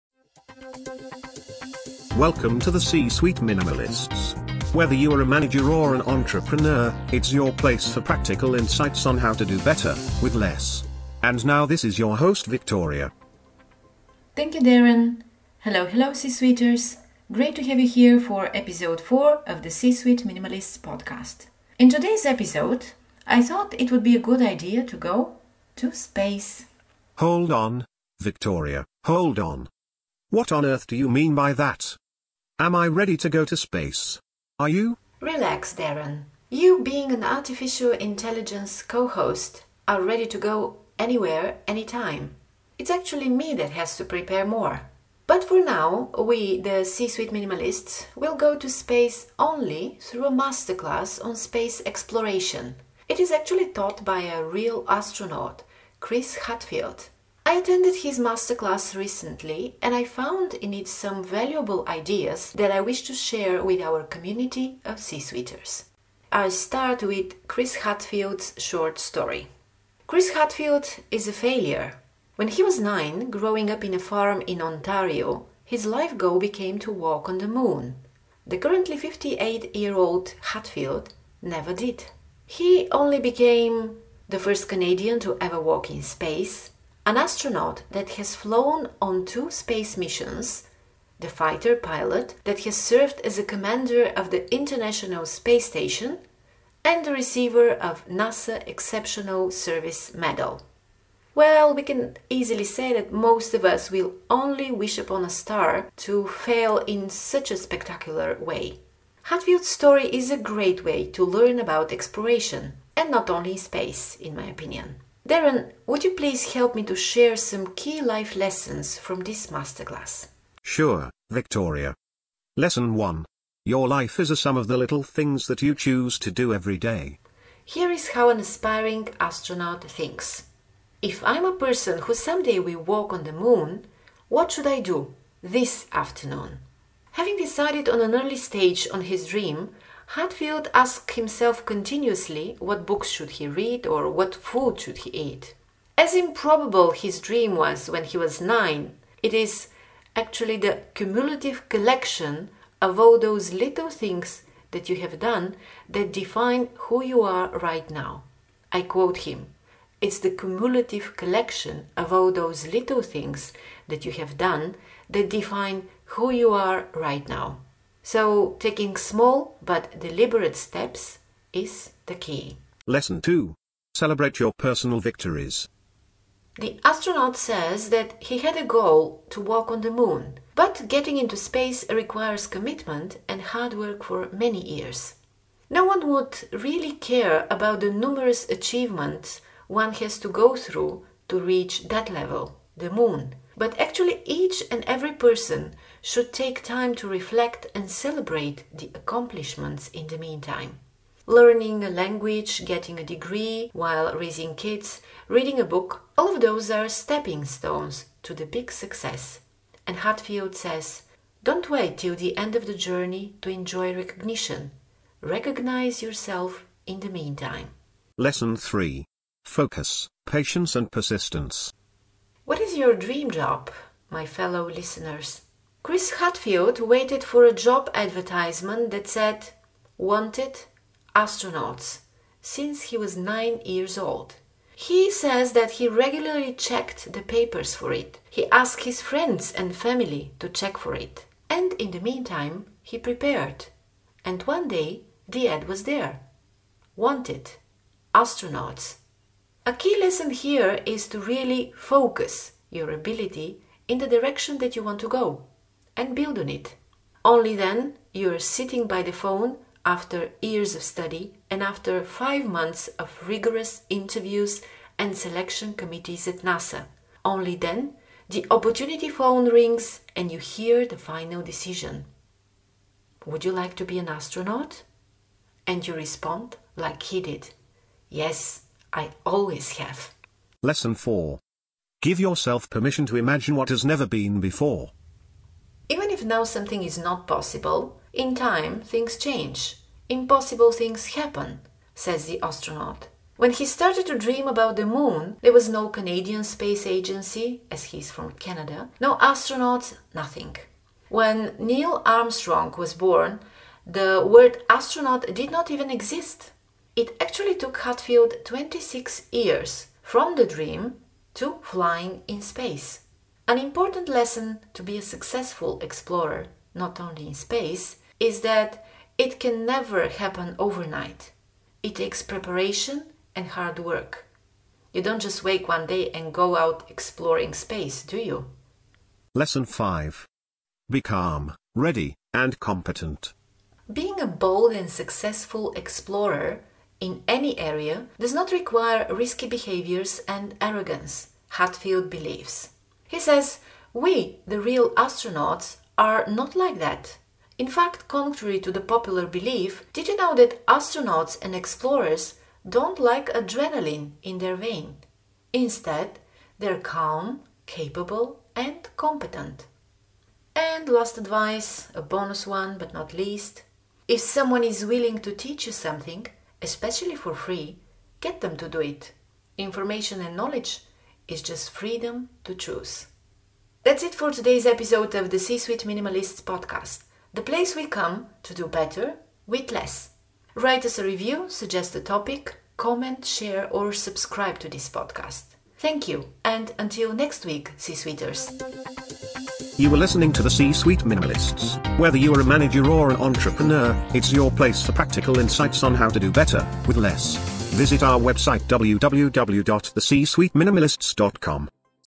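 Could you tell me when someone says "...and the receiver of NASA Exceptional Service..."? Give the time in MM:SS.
01:36.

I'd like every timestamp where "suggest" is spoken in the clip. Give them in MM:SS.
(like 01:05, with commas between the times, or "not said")
06:21.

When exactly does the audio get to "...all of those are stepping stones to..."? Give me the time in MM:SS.
03:26.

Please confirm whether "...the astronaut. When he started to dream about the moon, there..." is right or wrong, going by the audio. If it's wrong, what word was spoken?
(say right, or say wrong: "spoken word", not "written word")
right.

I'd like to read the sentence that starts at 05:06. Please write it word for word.
It actually took Hadfield 26 years from the dream to flying in space.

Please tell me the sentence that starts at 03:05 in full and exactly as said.
No one would really care about the numerous achievements one has to go through to reach that level, the moon.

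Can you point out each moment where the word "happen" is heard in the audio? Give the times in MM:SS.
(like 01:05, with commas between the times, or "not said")
04:51, 05:20.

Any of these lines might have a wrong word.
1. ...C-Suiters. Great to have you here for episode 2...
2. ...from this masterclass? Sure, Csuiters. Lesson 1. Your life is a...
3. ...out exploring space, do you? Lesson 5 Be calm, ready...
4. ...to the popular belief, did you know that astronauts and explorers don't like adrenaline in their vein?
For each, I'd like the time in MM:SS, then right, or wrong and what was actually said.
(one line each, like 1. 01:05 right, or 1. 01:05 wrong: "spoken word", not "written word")
1. 00:16 wrong: "4", not "2"
2. 01:58 wrong: "Victoria", not "Csuiters"
3. 05:26 right
4. 05:48 right.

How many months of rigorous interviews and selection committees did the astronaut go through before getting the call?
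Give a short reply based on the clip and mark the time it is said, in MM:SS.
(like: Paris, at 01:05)
5, at 04:22.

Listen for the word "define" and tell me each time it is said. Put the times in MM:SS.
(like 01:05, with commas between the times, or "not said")
02:36, 02:45.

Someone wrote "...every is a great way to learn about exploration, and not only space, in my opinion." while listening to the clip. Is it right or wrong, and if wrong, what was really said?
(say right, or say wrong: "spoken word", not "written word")
wrong: "story", not "every".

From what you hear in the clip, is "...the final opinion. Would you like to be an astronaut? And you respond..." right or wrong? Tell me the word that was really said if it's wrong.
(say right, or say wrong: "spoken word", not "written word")
wrong: "decision", not "opinion".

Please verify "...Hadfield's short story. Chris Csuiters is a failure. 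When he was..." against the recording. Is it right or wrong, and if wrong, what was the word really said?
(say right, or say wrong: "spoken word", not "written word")
wrong: "Hadfield", not "Csuiters".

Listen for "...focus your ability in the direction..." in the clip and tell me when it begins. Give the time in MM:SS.
04:11.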